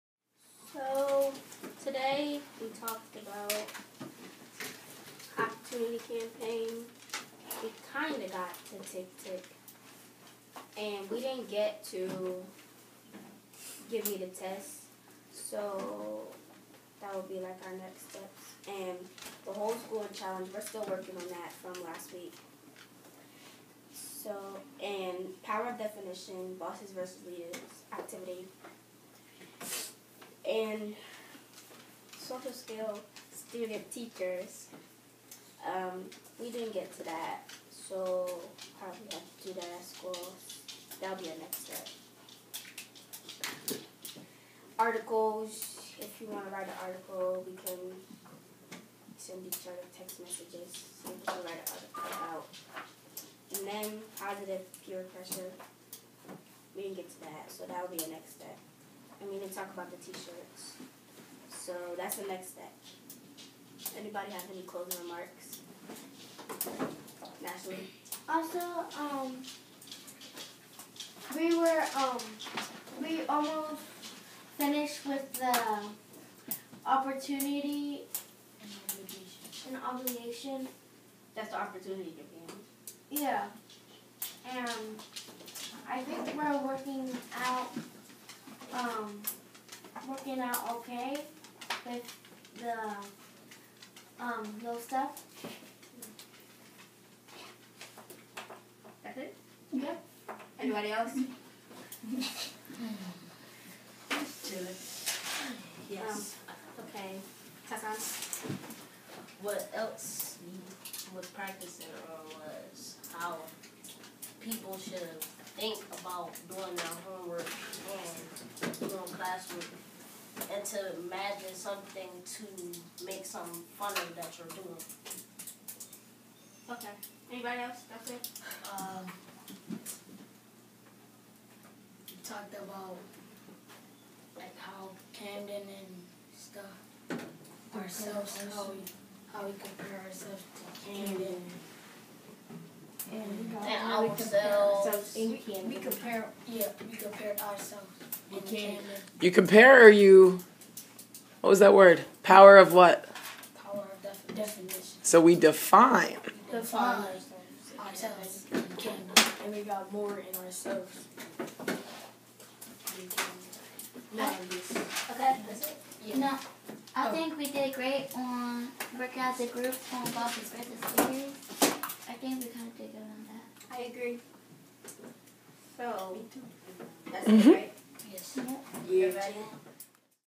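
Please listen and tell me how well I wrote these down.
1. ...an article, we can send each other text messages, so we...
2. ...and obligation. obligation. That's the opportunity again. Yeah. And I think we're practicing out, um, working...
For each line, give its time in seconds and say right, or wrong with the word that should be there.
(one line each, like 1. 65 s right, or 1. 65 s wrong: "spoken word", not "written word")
1. 46 s right
2. 79 s wrong: "working", not "practicing".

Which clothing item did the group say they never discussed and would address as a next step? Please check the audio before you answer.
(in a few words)
T-shirts.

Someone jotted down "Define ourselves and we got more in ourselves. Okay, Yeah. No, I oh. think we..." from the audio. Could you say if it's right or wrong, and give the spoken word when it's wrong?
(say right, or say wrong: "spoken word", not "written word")
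right.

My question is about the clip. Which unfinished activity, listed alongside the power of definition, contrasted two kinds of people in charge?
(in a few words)
Bosses versus leaders.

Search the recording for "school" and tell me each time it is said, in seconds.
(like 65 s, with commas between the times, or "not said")
19 s, 39 s.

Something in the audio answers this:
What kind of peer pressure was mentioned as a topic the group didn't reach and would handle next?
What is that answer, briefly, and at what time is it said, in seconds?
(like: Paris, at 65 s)
Positive, at 54 s.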